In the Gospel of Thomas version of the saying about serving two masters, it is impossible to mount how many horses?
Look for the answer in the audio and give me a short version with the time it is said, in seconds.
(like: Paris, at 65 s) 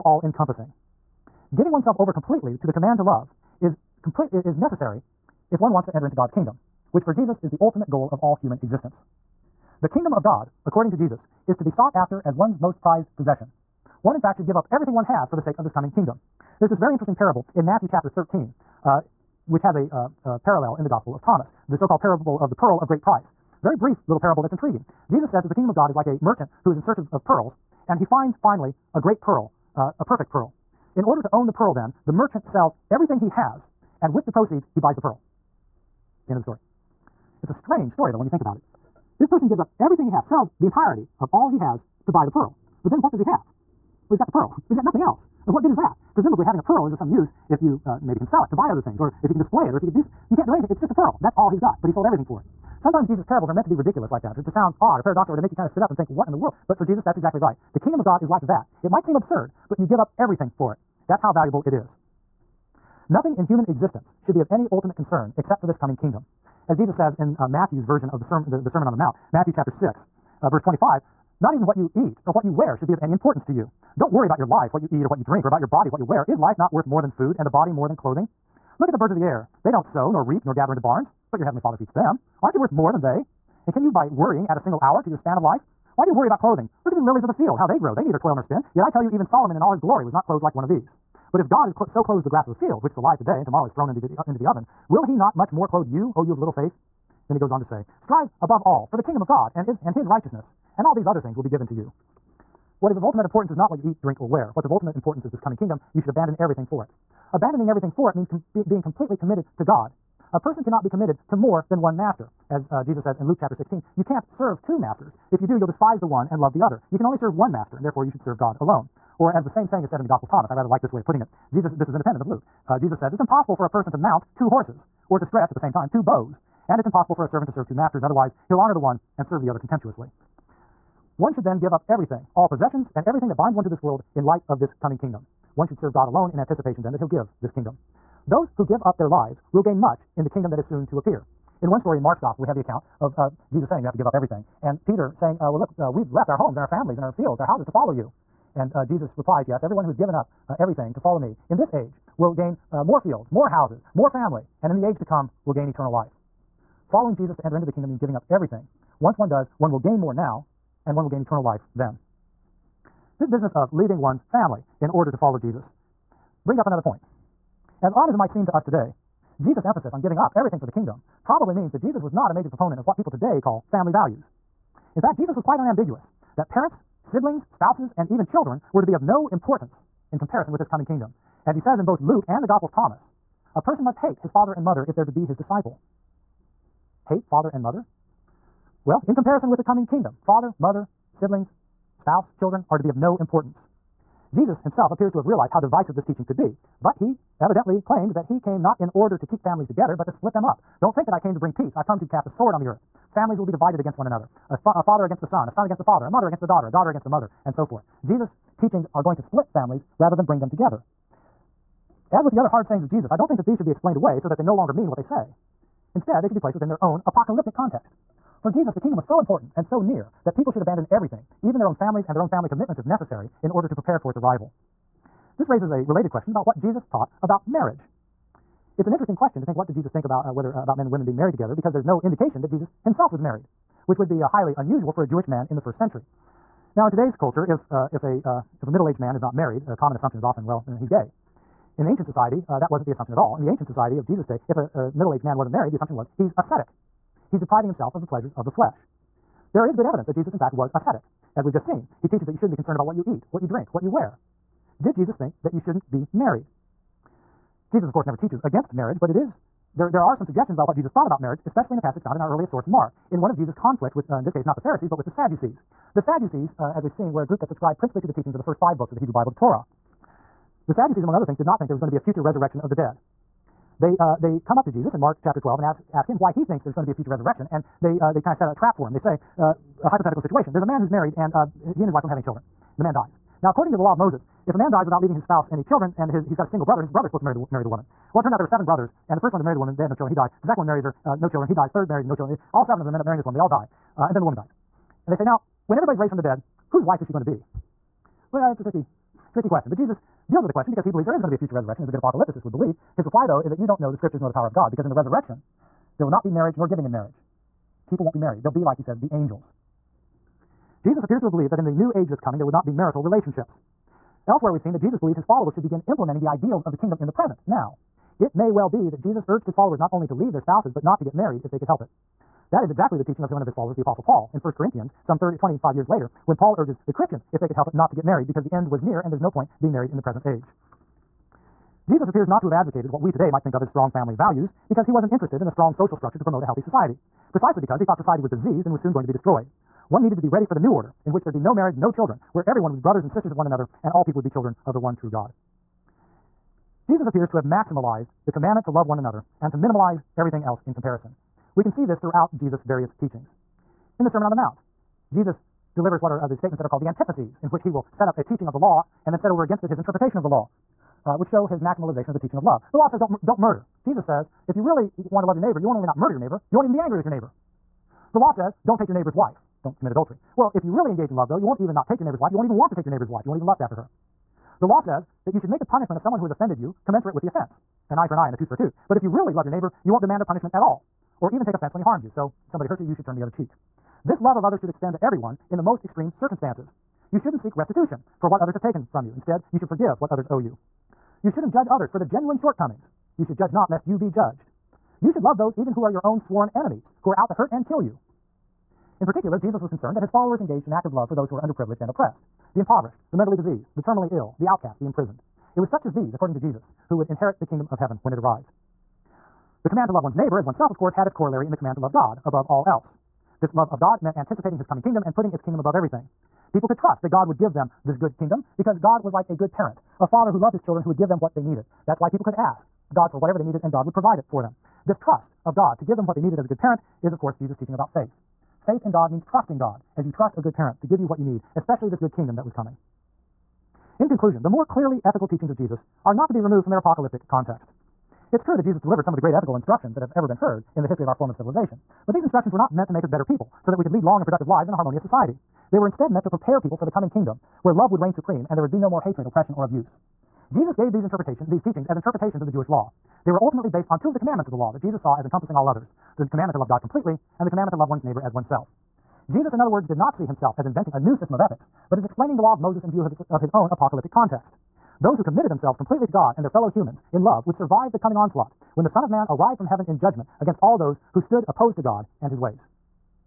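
2, at 124 s.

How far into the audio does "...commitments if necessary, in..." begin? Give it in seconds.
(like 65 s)
222 s.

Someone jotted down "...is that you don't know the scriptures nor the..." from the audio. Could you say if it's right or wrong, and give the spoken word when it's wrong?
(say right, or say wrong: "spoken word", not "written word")
right.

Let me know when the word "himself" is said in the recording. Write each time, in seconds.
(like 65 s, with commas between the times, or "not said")
194 s, 232 s, 247 s, 460 s.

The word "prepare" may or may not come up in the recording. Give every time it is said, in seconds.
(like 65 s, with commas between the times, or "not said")
223 s, 446 s.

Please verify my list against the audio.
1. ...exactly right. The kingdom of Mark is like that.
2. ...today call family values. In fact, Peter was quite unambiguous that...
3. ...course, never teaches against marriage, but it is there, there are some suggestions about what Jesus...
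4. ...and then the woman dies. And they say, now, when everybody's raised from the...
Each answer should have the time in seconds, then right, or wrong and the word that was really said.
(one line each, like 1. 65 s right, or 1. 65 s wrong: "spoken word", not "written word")
1. 57 s wrong: "God", not "Mark"
2. 173 s wrong: "Jesus", not "Peter"
3. 257 s right
4. 294 s right.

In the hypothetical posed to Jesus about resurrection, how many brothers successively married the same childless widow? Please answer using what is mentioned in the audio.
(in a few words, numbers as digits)
7.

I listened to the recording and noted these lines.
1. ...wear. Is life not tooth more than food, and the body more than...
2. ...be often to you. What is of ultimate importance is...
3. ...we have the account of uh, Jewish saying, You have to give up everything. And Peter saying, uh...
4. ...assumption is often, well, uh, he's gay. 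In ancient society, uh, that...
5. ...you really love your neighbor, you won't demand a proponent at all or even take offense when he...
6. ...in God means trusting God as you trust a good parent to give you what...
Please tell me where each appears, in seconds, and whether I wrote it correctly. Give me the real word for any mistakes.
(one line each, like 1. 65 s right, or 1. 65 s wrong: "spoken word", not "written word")
1. 76 s wrong: "worth", not "tooth"
2. 101 s wrong: "given", not "often"
3. 142 s wrong: "Jesus", not "Jewish"
4. 239 s right
5. 379 s wrong: "punishment", not "proponent"
6. 428 s right.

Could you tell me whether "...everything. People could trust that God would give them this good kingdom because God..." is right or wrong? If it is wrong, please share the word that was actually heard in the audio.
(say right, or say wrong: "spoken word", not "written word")
right.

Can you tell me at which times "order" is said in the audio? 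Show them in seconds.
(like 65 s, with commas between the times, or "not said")
31 s, 164 s, 198 s, 223 s, 340 s.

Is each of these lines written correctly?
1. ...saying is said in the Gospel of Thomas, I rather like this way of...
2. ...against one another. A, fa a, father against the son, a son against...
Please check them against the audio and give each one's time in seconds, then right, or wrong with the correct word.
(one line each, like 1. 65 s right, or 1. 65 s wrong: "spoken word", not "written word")
1. 119 s right
2. 203 s right.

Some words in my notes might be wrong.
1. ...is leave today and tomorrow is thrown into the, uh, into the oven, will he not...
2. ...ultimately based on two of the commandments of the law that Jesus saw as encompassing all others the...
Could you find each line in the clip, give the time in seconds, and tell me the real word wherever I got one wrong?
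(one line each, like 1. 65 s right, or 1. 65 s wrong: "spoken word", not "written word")
1. 92 s wrong: "alive", not "leave"
2. 453 s right.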